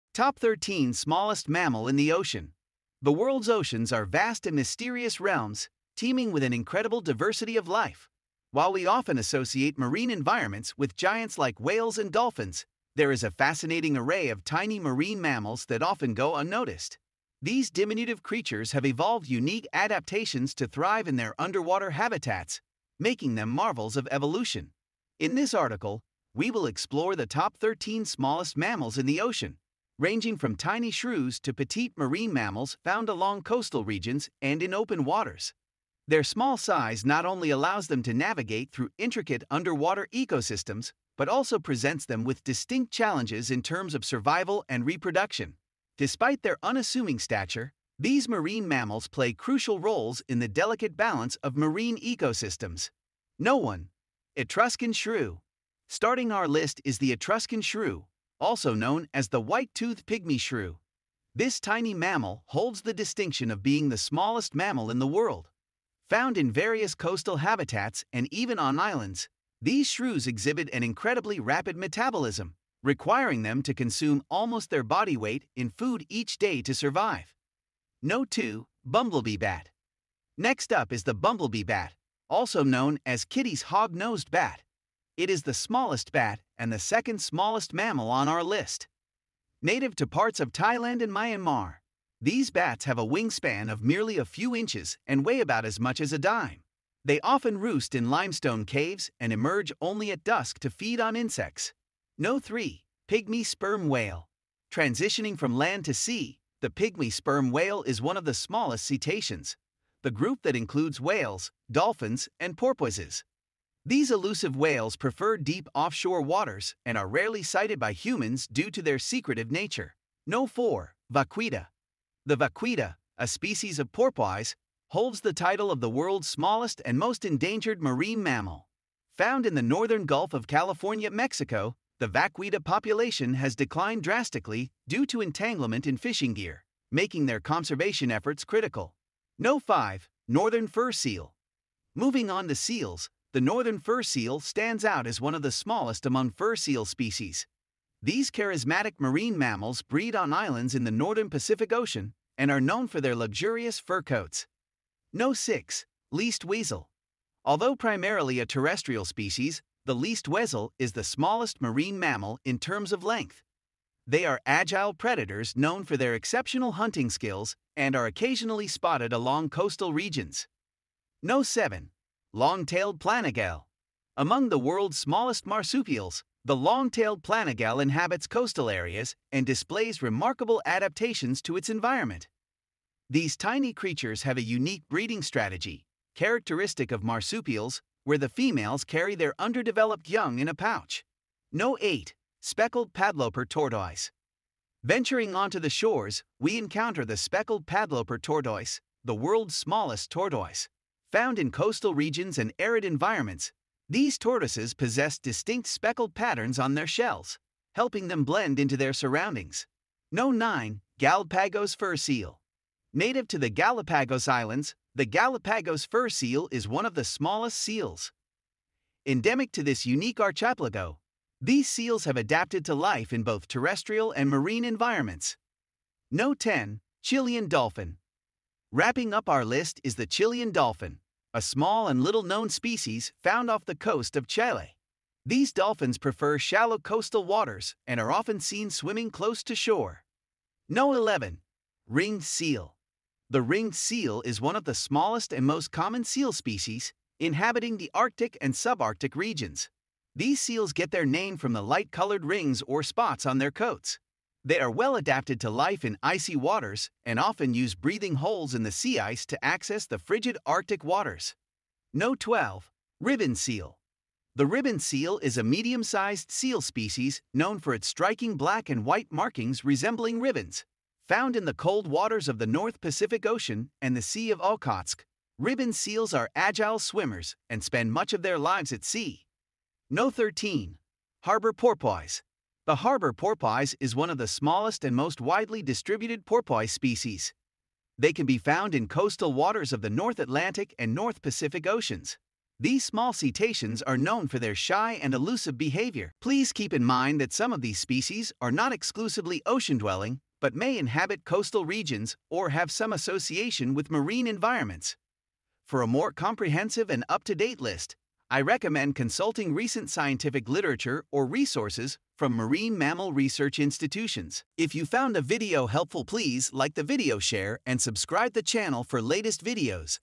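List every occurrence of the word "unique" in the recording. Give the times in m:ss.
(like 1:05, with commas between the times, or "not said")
0:19, 3:04, 3:39.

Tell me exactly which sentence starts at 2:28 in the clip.
These charismatic marine mammals breed on islands in the northern Pacific Ocean and are known for their luxurious fur coats.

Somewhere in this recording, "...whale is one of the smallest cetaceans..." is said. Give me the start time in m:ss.
1:47.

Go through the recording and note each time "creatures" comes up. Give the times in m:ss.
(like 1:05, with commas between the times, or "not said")
0:18, 3:03.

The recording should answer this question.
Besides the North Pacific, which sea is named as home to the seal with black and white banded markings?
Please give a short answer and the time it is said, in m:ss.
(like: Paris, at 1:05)
Sea of Okhotsk, at 4:34.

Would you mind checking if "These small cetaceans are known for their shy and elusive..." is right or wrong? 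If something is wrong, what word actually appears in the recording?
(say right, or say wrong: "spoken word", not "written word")
right.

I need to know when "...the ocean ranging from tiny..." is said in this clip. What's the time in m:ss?
0:29.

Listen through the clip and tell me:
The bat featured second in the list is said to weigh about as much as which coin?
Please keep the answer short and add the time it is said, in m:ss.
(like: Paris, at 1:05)
A dime, at 1:36.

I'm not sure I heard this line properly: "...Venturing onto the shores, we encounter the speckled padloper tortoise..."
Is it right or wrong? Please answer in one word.
right.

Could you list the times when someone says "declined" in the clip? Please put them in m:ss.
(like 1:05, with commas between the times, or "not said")
2:13.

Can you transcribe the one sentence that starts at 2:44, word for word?
They are agile predators known for their exceptional hunting skills and are occasionally spotted along coastal regions.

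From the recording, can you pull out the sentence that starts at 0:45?
Despite their unassuming stature, these marine mammals play crucial roles in the delicate balance of marine ecosystems.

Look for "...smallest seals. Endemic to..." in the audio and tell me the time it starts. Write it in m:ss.
3:37.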